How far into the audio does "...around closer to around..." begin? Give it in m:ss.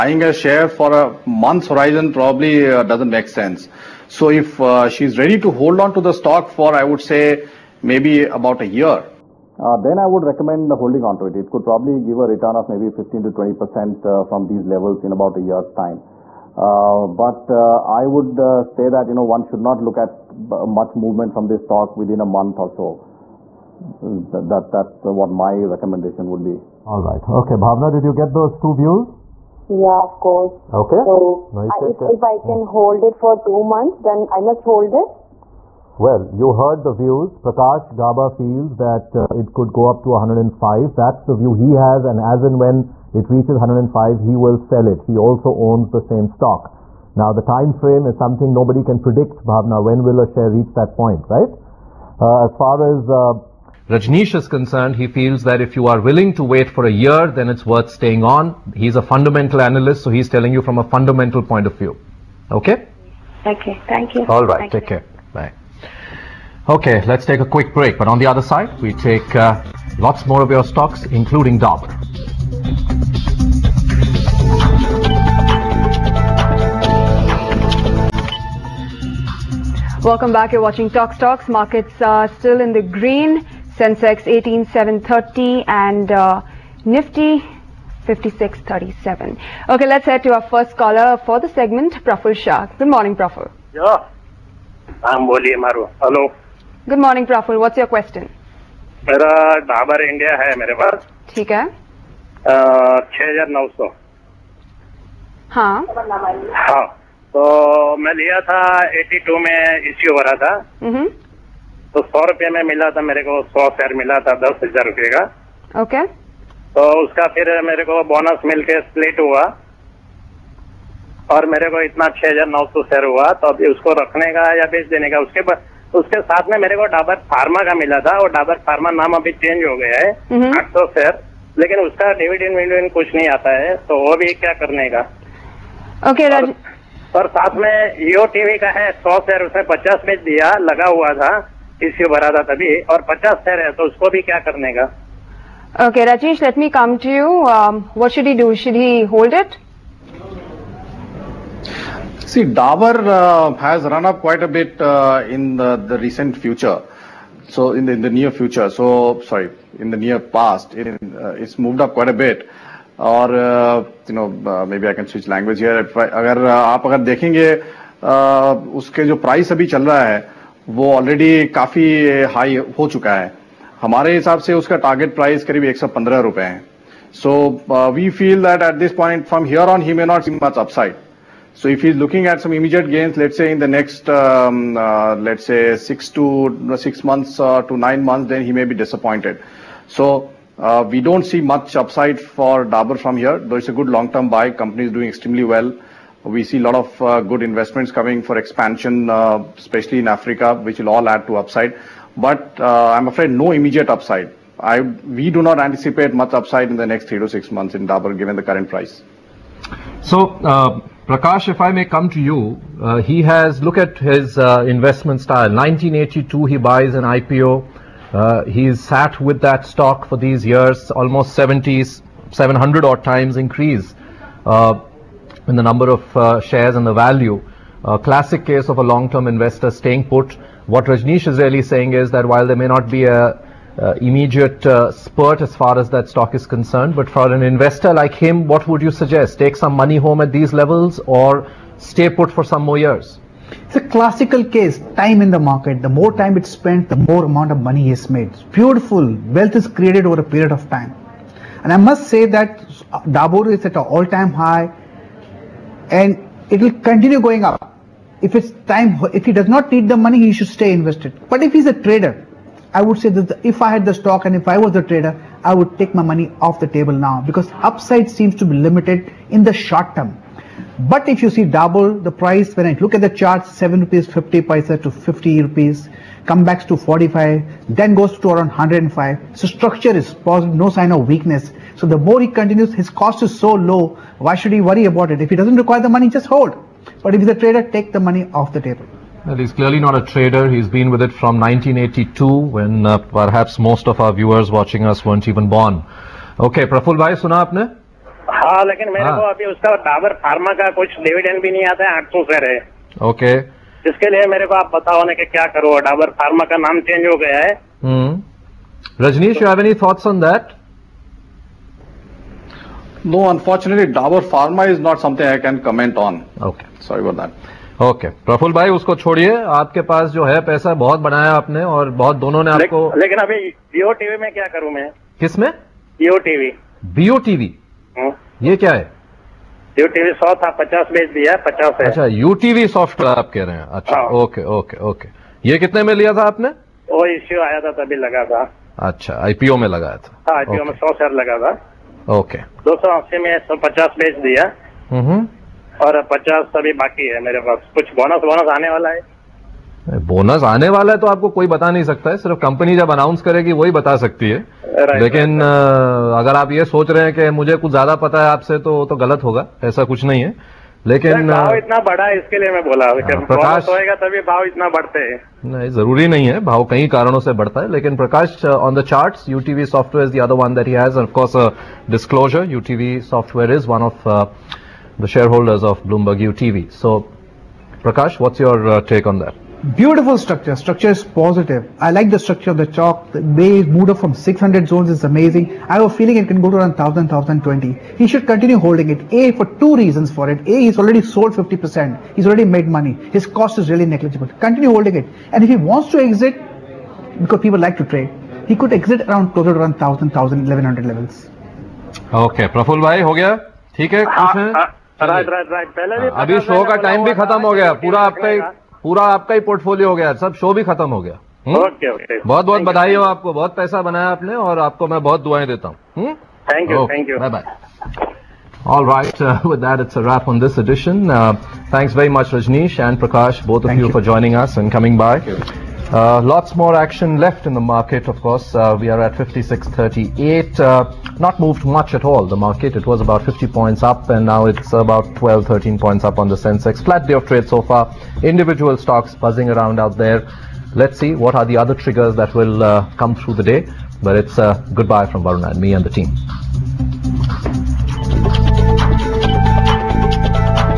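6:39.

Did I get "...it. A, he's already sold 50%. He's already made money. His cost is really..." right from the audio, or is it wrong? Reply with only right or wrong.
right.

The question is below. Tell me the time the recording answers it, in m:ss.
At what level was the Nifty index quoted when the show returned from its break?
1:26.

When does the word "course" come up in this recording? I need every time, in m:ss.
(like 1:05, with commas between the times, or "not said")
0:30, 7:08.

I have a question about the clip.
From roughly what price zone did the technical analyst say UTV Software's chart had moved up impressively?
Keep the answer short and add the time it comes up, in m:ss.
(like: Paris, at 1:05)
600, at 6:24.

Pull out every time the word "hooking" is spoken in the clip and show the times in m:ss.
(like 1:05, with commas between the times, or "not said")
not said.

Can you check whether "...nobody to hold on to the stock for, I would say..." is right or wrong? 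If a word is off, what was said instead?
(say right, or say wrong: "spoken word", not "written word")
wrong: "ready", not "nobody".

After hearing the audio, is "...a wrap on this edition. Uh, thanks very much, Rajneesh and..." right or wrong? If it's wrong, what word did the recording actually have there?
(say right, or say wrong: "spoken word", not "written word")
right.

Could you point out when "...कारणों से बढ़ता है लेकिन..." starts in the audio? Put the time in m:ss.
6:06.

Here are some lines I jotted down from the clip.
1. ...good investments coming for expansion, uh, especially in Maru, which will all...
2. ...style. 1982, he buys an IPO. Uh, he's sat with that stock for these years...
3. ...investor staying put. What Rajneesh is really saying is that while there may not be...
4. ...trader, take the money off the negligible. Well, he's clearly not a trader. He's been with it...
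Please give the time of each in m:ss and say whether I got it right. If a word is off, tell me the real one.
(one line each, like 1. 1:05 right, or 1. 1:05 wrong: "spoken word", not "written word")
1. 3:17 wrong: "Africa", not "Maru"
2. 3:35 right
3. 3:49 right
4. 4:47 wrong: "table", not "negligible".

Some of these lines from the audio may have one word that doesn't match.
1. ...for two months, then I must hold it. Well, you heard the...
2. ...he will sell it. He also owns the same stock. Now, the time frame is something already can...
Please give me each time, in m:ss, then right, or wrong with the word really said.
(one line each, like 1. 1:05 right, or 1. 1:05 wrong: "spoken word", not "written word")
1. 0:33 right
2. 0:44 wrong: "nobody", not "already".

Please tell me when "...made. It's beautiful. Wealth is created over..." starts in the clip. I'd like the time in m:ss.
4:08.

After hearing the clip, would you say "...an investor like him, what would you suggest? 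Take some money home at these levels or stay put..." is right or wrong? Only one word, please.
right.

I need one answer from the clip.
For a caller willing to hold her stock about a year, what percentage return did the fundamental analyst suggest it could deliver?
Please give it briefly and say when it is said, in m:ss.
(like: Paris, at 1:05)
15 to 20%, at 0:12.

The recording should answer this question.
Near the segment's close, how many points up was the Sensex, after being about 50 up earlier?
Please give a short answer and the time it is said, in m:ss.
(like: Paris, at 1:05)
12 to 13, at 7:15.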